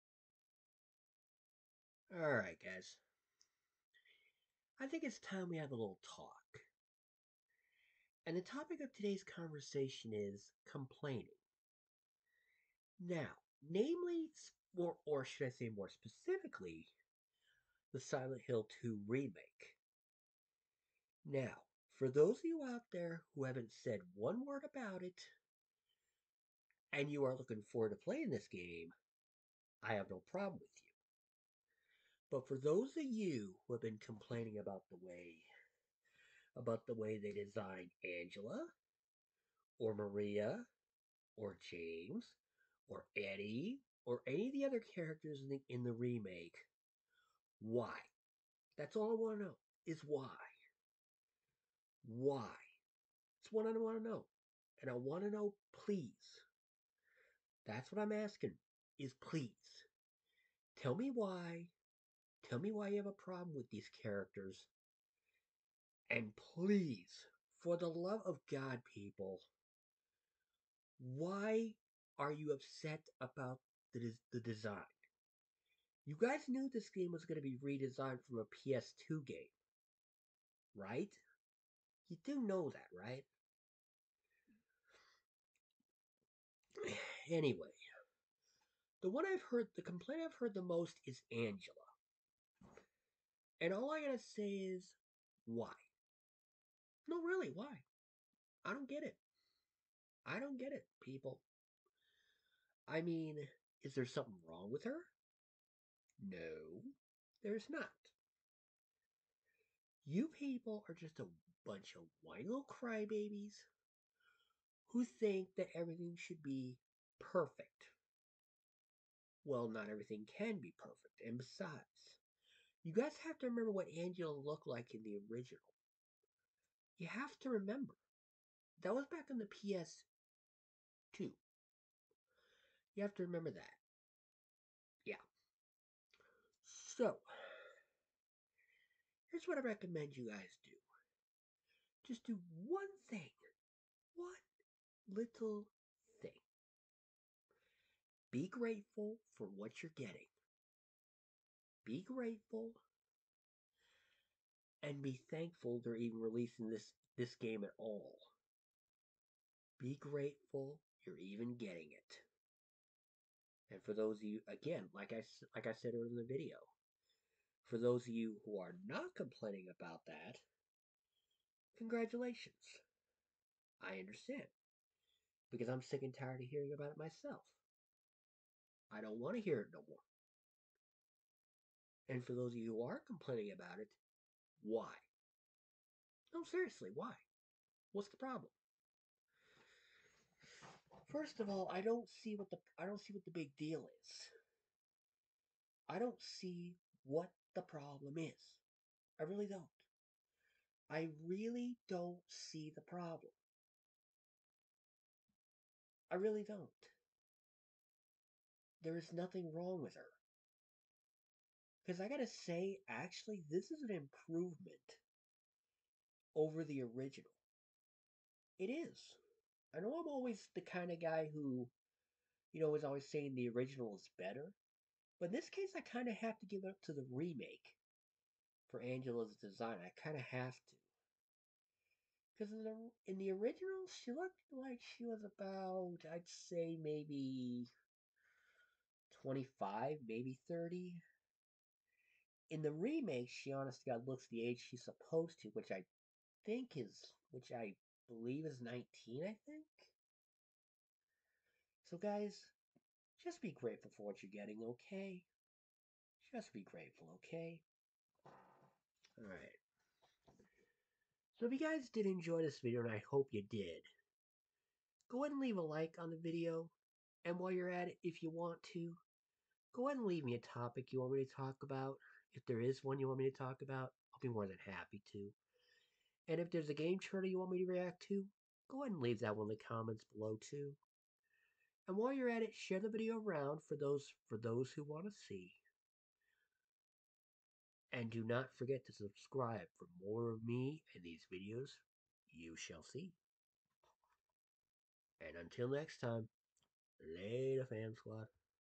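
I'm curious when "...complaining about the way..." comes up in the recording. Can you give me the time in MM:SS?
00:34.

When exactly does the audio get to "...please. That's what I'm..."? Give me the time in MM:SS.
00:55.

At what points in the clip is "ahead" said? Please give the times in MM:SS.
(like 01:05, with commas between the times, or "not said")
04:25, 04:29, 04:38.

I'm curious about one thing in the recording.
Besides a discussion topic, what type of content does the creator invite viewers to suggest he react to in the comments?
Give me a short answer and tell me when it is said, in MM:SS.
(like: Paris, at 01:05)
game trailer, at 04:36.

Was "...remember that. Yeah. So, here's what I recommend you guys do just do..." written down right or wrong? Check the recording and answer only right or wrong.
right.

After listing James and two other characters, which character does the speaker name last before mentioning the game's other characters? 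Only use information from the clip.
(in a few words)
Eddie.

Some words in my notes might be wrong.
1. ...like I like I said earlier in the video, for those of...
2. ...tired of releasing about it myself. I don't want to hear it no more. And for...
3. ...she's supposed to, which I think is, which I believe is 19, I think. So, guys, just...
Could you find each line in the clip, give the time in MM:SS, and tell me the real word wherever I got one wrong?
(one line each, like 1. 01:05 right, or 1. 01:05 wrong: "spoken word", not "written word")
1. 02:44 right
2. 02:56 wrong: "hearing", not "releasing"
3. 04:04 right.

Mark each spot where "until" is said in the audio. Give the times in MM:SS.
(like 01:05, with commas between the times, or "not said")
04:55.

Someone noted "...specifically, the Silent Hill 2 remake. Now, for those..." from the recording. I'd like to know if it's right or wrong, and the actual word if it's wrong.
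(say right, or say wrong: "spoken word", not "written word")
right.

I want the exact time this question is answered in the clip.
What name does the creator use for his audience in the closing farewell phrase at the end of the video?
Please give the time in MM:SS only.
04:57.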